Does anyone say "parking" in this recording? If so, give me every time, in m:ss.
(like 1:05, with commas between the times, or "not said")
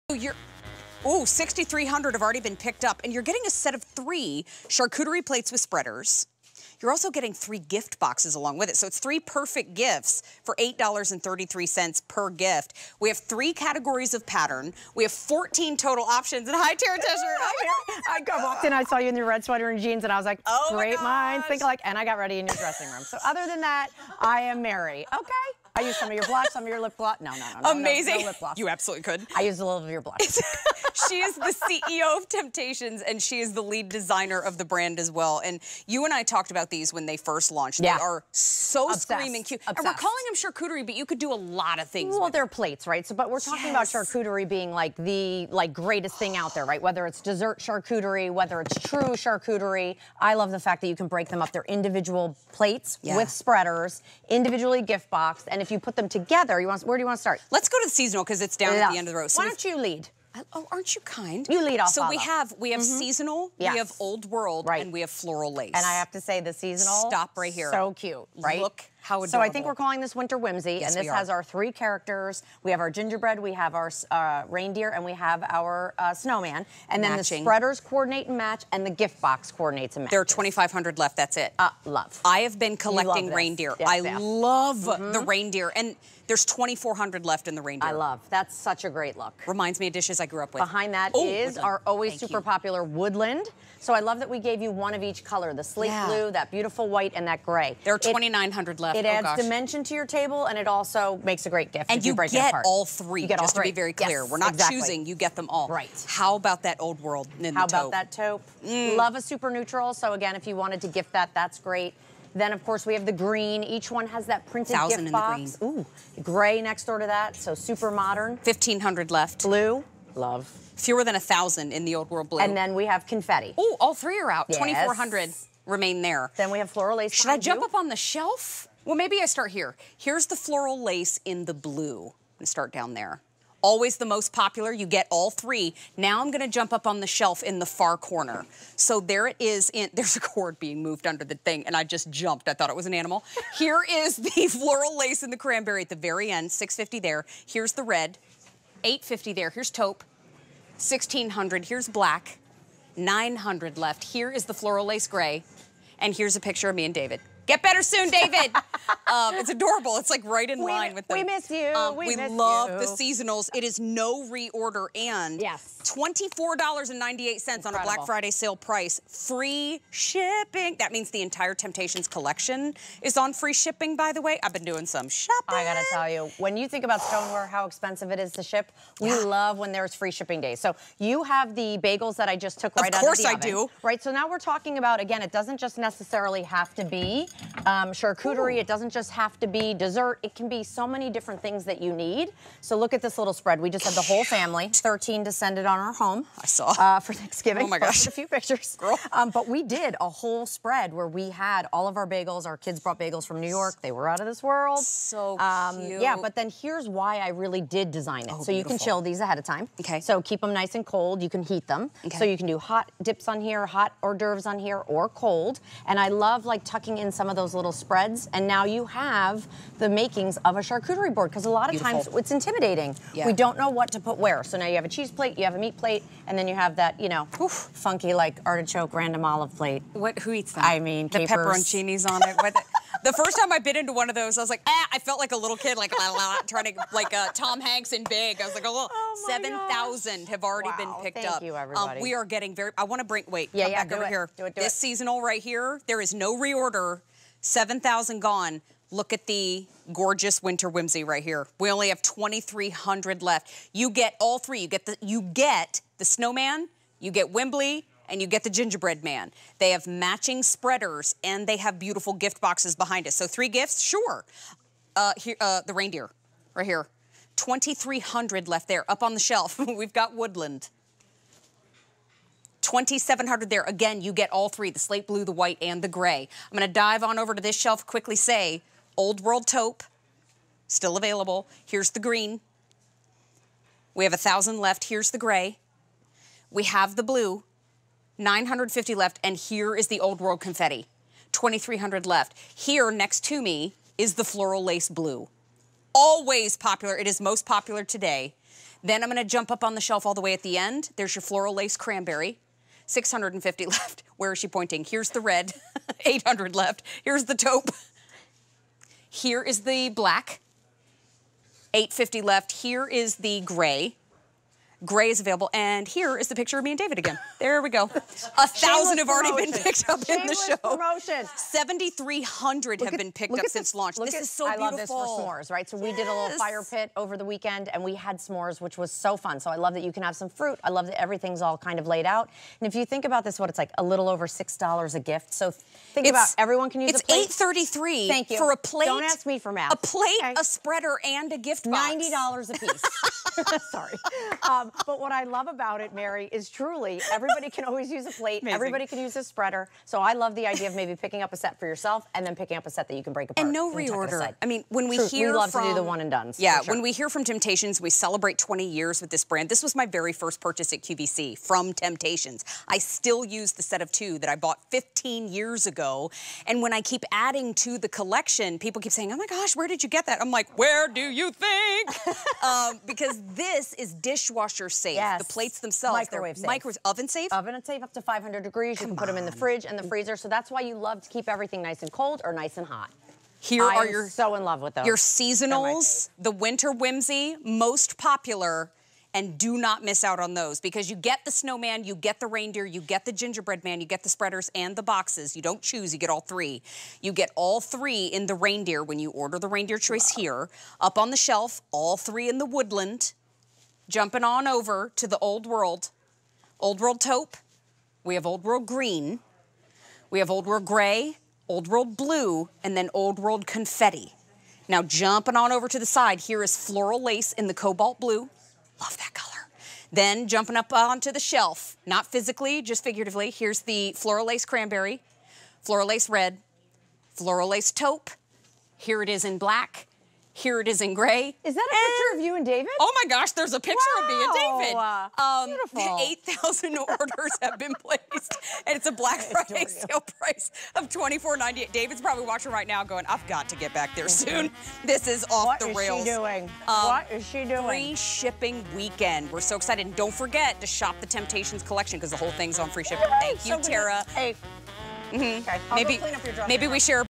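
not said.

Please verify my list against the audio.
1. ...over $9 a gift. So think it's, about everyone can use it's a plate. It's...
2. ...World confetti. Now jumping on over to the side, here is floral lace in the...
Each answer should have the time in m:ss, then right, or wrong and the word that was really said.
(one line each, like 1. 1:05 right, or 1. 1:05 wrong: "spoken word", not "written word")
1. 5:34 wrong: "6", not "9"
2. 6:53 right.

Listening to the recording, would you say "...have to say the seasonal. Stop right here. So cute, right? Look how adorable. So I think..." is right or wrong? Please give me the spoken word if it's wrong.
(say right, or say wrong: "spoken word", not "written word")
right.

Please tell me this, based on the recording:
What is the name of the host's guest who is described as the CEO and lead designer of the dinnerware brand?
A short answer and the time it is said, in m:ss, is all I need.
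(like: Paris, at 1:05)
Tara Tesher, at 0:16.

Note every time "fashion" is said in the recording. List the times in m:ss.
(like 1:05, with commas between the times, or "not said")
not said.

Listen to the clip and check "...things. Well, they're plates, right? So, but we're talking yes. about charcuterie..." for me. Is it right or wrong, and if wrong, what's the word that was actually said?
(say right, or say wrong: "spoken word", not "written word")
right.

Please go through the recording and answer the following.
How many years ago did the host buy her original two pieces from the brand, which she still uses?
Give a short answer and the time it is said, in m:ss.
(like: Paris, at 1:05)
15, at 6:04.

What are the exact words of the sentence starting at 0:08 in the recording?
So it's three perfect gifts for $8.33 per gift.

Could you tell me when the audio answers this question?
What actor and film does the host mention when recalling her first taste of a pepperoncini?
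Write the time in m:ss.
3:57.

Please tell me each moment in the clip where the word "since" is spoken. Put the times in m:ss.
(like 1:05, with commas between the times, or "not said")
5:23.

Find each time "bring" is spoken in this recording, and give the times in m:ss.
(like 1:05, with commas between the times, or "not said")
4:03.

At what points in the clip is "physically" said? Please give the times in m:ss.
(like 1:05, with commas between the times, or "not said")
7:02.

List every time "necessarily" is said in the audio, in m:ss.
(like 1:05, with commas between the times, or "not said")
3:05.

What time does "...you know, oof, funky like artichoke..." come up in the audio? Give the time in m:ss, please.
3:46.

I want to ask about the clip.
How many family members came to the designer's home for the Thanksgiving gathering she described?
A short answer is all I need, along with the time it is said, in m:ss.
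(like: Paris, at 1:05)
13, at 3:14.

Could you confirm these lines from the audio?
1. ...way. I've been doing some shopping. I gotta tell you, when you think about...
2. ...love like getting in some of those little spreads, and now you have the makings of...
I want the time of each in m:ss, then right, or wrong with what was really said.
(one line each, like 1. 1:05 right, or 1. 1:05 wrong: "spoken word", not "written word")
1. 2:54 right
2. 3:36 wrong: "tucking", not "getting".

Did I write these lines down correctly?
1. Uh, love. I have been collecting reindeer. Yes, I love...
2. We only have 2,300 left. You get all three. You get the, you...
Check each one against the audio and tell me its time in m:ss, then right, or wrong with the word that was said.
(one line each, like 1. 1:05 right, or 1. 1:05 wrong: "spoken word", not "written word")
1. 1:21 right
2. 4:11 right.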